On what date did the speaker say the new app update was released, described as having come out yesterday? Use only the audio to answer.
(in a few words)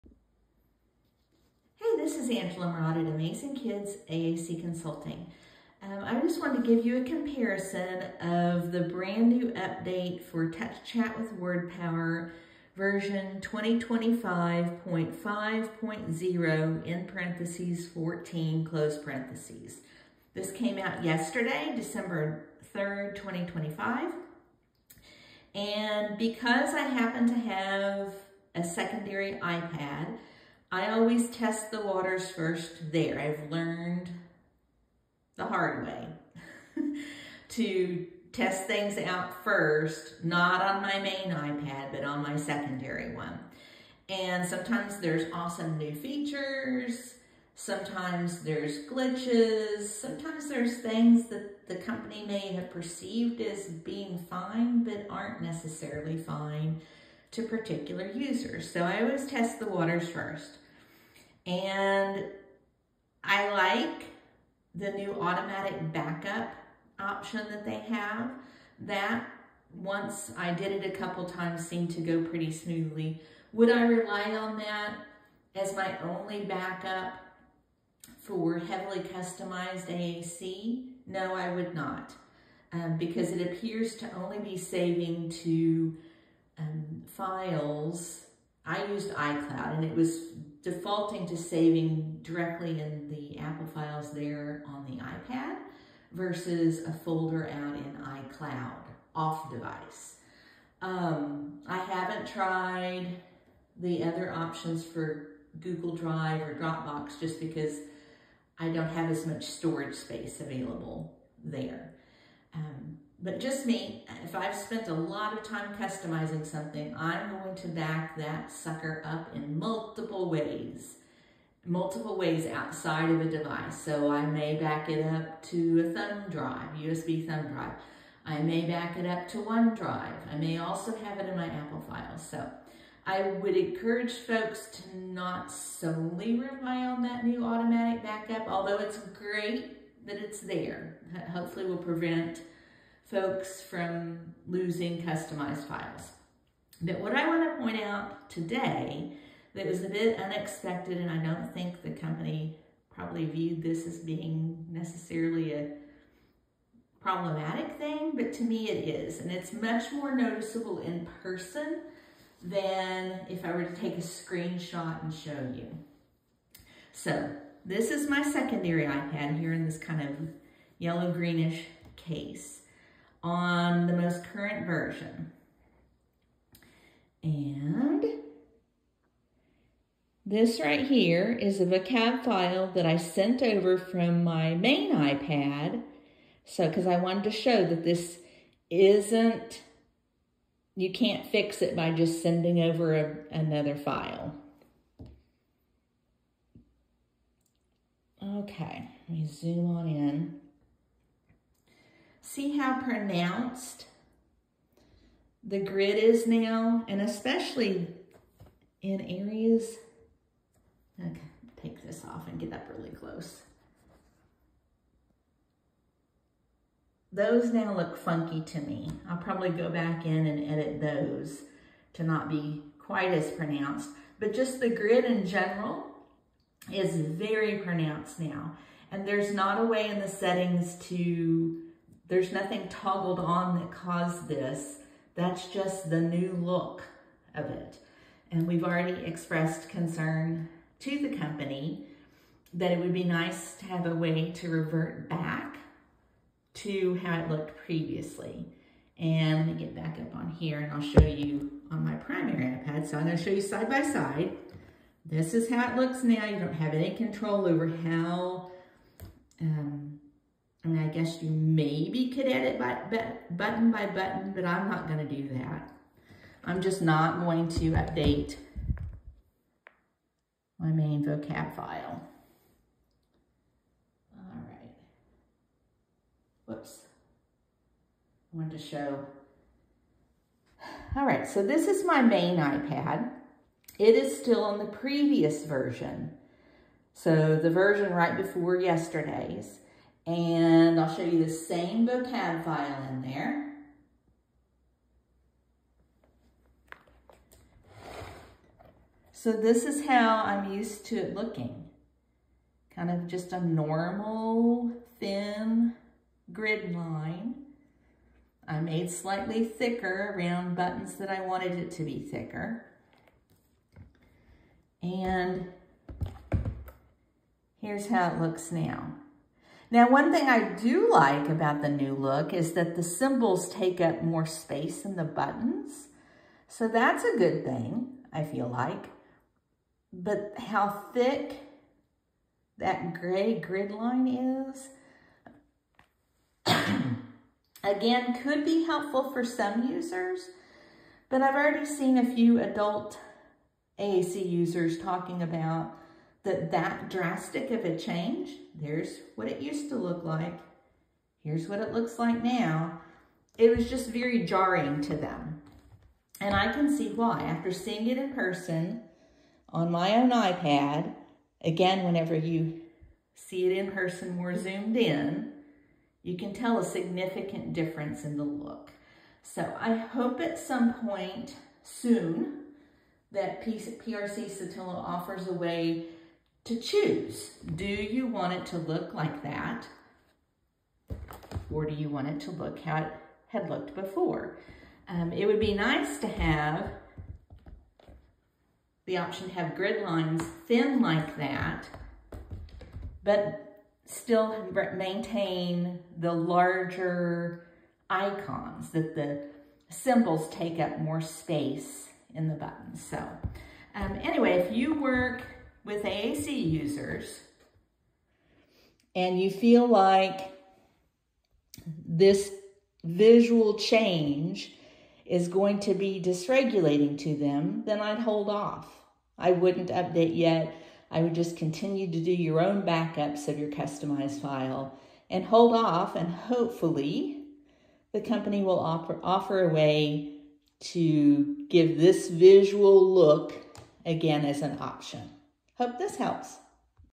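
December 3rd, 2025.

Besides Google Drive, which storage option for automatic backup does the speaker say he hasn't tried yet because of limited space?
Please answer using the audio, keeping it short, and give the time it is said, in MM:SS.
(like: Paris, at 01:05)
Dropbox, at 01:46.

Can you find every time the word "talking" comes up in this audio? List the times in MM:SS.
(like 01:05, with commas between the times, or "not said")
05:44.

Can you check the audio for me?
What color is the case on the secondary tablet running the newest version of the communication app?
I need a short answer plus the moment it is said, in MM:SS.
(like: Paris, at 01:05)
Yellow greenish, at 02:50.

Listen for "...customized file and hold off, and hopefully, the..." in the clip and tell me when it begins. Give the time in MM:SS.
07:03.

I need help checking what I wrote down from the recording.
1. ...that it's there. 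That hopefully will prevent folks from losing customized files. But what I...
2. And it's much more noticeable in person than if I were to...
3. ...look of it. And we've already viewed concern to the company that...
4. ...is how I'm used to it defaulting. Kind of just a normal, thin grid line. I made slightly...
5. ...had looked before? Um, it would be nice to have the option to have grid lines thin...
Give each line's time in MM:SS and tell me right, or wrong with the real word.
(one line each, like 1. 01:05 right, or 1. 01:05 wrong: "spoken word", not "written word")
1. 02:20 right
2. 02:39 right
3. 03:56 wrong: "expressed", not "viewed"
4. 04:59 wrong: "looking", not "defaulting"
5. 06:23 right.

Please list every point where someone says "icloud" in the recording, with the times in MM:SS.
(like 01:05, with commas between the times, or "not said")
01:29, 01:38.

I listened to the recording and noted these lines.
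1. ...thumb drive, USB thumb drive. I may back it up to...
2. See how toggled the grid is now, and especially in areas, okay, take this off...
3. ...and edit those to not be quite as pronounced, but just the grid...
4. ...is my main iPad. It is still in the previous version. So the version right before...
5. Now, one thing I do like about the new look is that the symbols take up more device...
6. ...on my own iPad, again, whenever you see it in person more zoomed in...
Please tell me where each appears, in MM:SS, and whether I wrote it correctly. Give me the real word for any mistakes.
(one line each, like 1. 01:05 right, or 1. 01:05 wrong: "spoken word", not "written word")
1. 02:05 right
2. 03:22 wrong: "pronounced", not "toggled"
3. 03:40 right
4. 04:41 right
5. 05:19 wrong: "space", not "device"
6. 05:59 right.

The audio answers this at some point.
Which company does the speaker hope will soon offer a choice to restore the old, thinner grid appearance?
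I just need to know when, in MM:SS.
06:13.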